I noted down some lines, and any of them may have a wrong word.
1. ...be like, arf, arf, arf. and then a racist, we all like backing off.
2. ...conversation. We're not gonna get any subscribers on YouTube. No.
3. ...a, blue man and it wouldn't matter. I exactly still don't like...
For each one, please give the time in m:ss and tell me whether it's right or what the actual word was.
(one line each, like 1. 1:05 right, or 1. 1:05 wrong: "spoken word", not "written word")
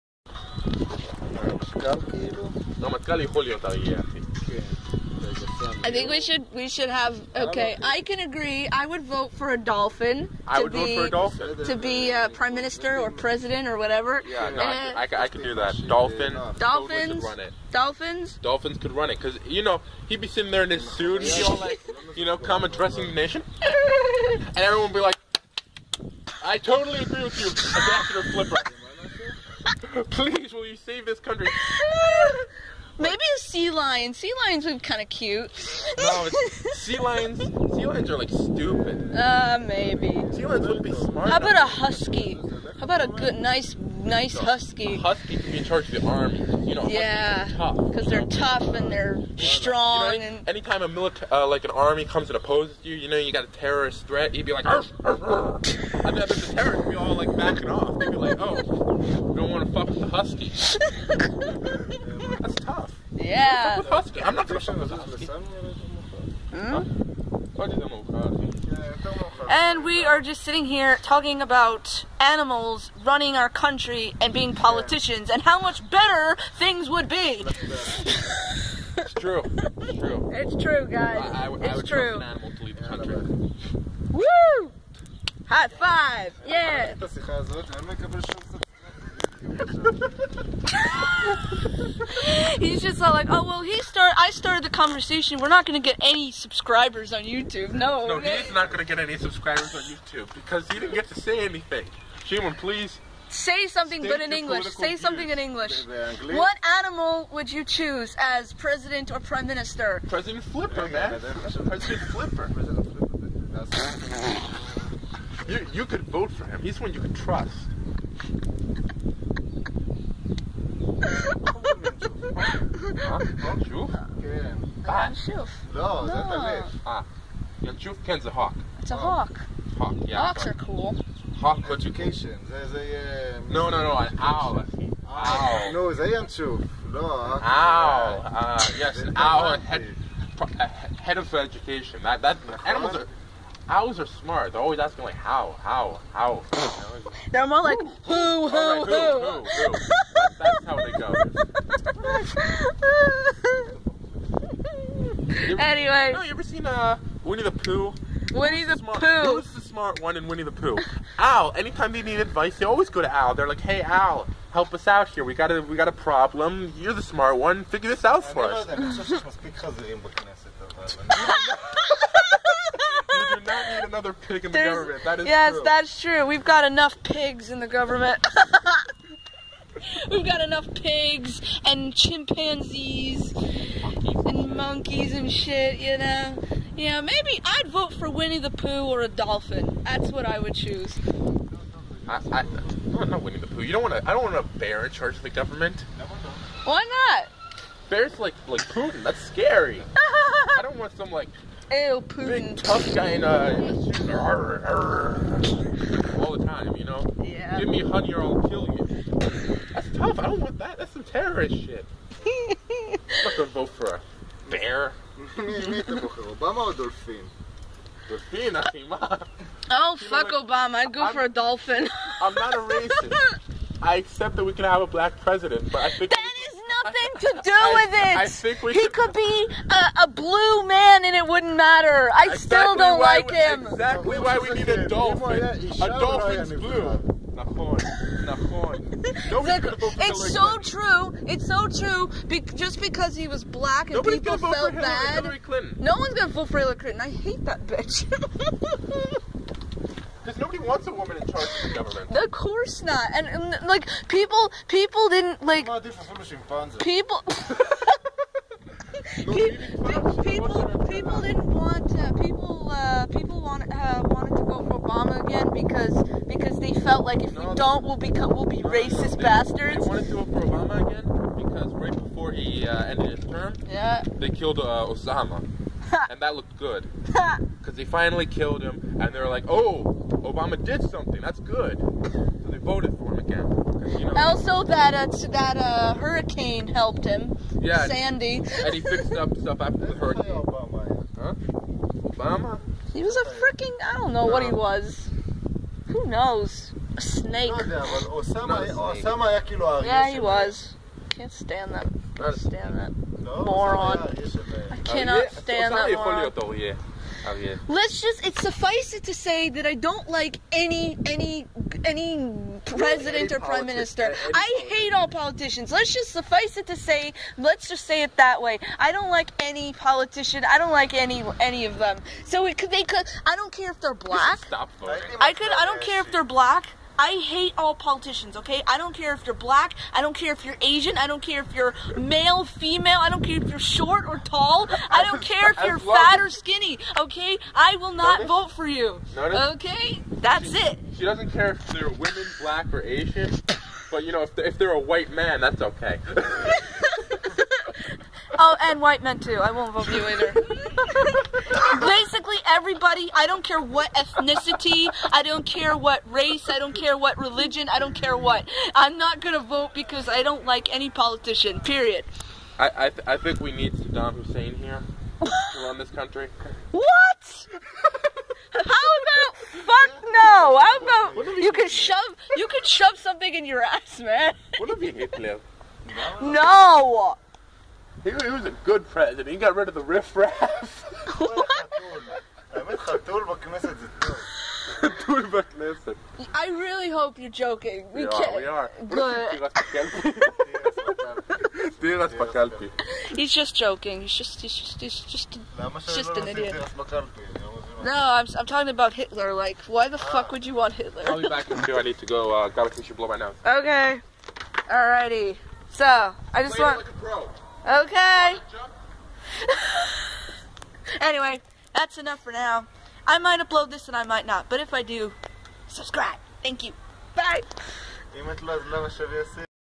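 1. 0:54 wrong: "terrorist", not "racist"
2. 1:34 right
3. 3:50 right.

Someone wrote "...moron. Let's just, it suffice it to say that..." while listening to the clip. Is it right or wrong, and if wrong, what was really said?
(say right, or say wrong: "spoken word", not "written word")
right.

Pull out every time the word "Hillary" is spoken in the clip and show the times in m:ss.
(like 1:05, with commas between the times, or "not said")
4:06.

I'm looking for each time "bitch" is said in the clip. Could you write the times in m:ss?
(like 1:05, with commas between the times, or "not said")
4:07.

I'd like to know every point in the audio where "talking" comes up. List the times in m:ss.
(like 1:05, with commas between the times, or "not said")
1:11, 6:38.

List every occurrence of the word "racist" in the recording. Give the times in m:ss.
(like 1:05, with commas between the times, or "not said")
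3:42, 4:28.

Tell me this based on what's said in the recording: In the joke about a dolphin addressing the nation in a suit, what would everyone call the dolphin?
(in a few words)
Ambassador Flipper.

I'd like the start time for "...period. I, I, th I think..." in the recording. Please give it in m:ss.
6:01.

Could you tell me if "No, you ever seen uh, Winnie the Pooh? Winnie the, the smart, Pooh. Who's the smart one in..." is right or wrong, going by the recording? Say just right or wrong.
right.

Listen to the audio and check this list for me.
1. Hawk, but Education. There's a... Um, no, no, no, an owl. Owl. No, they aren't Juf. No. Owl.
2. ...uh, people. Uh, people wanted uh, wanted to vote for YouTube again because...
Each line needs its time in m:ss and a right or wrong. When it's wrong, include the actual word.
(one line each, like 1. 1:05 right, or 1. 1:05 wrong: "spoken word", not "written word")
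1. 2:11 right
2. 4:21 wrong: "Obama", not "YouTube".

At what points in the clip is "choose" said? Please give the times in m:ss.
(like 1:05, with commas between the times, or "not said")
1:47, 3:10.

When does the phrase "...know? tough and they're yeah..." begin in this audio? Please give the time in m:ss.
0:48.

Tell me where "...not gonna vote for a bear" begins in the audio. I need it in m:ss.
3:33.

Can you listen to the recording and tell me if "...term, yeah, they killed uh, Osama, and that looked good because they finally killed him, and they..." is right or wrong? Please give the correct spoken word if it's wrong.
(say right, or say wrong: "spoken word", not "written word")
right.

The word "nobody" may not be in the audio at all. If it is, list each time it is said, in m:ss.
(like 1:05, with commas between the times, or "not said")
4:03, 4:10.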